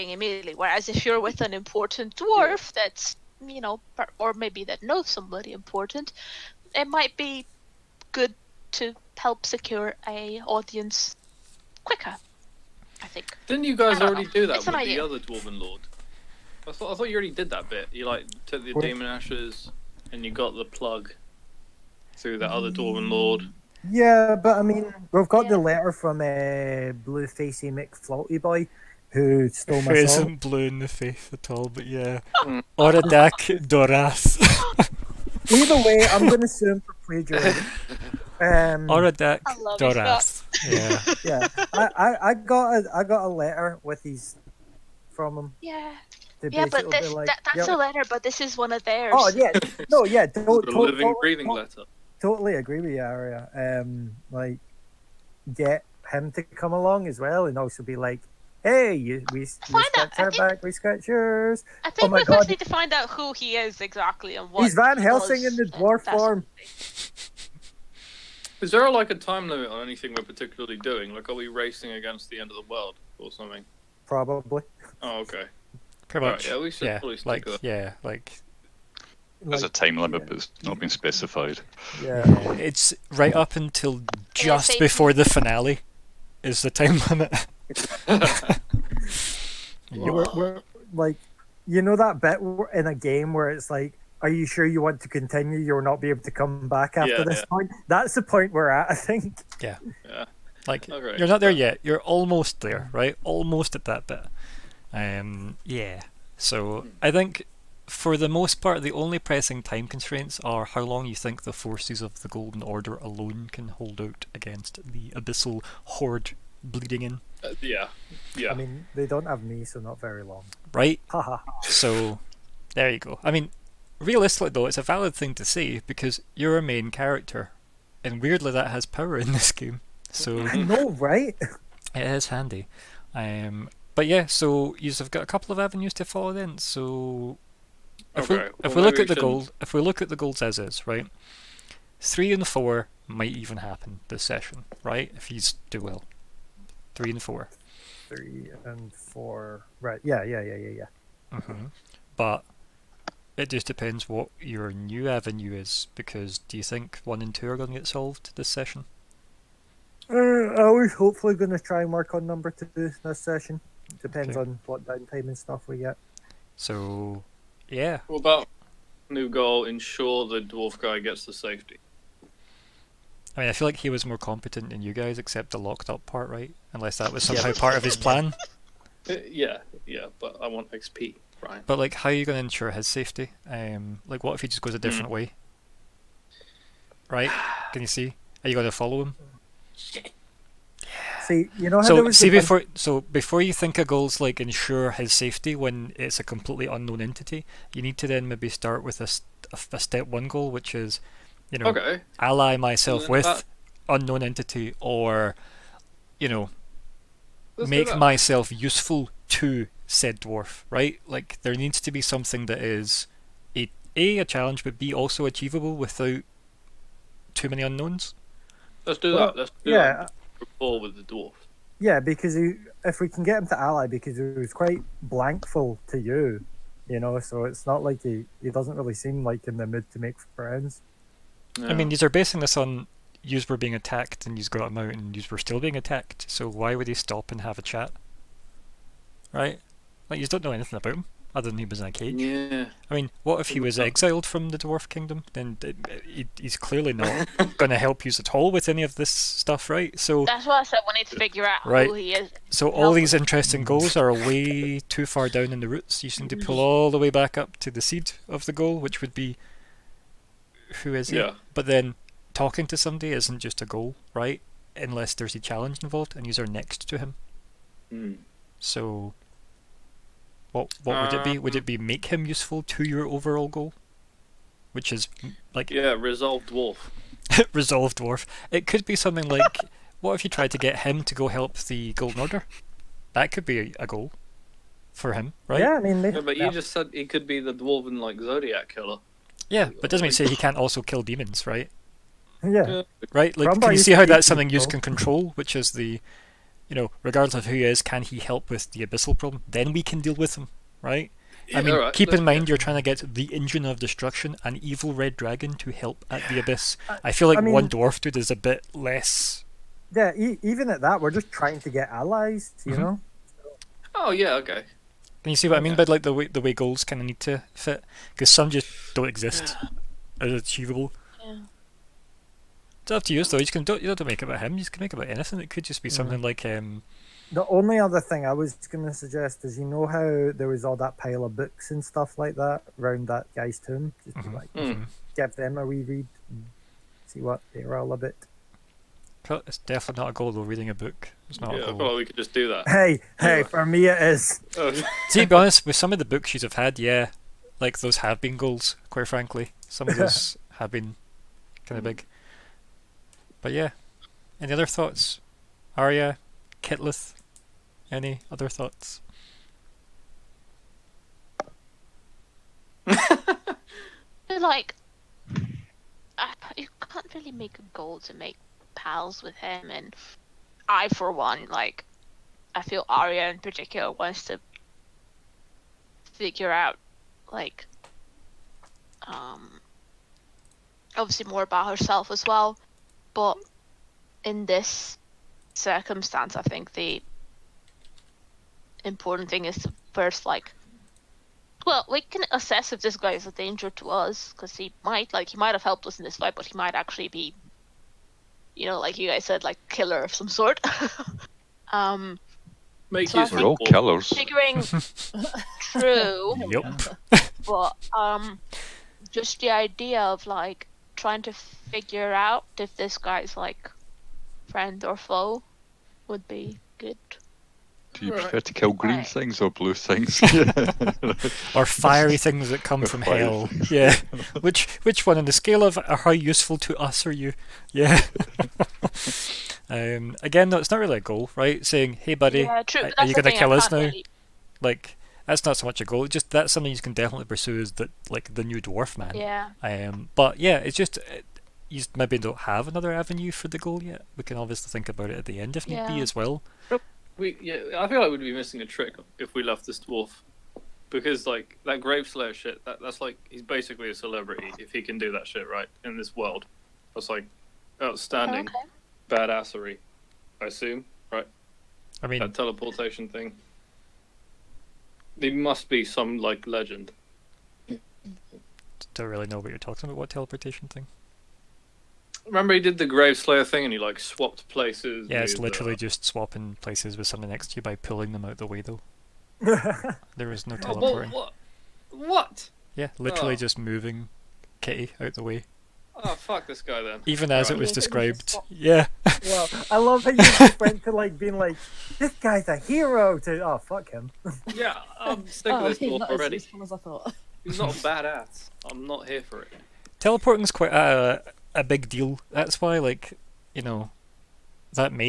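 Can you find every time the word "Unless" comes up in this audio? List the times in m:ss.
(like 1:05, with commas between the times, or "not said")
2:56, 4:24.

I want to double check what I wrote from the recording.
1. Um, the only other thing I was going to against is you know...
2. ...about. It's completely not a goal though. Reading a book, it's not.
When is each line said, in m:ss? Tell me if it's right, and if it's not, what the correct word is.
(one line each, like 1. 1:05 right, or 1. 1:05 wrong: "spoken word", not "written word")
1. 5:26 wrong: "suggest", not "against"
2. 5:37 wrong: "definitely", not "completely".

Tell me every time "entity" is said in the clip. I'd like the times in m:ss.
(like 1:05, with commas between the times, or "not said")
3:17, 3:24.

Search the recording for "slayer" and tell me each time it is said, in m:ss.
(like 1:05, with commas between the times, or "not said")
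7:32, 7:53.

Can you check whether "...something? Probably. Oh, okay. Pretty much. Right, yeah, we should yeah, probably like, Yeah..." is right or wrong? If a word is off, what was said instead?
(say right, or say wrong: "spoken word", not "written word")
right.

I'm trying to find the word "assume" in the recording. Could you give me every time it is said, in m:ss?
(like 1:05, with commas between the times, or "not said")
0:36, 7:40.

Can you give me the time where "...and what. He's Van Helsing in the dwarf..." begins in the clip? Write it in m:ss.
1:04.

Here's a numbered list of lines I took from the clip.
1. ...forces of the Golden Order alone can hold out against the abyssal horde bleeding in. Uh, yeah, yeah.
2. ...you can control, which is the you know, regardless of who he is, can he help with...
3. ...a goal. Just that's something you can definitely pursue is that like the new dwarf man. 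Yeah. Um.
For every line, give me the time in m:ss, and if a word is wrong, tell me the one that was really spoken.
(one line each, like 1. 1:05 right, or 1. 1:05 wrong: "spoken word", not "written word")
1. 1:51 right
2. 4:54 right
3. 7:15 right.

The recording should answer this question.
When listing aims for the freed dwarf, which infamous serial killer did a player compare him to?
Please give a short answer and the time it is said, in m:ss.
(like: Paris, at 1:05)
Zodiac killer, at 4:48.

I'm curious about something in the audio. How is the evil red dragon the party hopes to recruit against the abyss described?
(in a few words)
engine of destruction.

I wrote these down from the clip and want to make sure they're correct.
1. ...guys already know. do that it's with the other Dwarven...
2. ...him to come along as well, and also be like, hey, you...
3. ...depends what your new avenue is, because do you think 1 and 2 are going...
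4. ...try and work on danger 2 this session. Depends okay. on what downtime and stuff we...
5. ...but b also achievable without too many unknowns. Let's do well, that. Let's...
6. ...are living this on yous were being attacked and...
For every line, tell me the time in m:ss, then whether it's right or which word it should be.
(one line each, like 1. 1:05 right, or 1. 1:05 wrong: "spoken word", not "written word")
1. 0:13 right
2. 0:56 right
3. 2:33 right
4. 2:41 wrong: "number", not "danger"
5. 3:34 right
6. 3:52 wrong: "basing", not "living".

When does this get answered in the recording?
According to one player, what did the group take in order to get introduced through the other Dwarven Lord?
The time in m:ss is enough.
0:18.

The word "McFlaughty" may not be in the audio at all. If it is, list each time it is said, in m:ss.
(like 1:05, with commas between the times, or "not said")
0:27.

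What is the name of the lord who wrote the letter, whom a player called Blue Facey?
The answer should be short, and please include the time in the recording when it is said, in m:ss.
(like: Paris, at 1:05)
Oradak Doras, at 0:32.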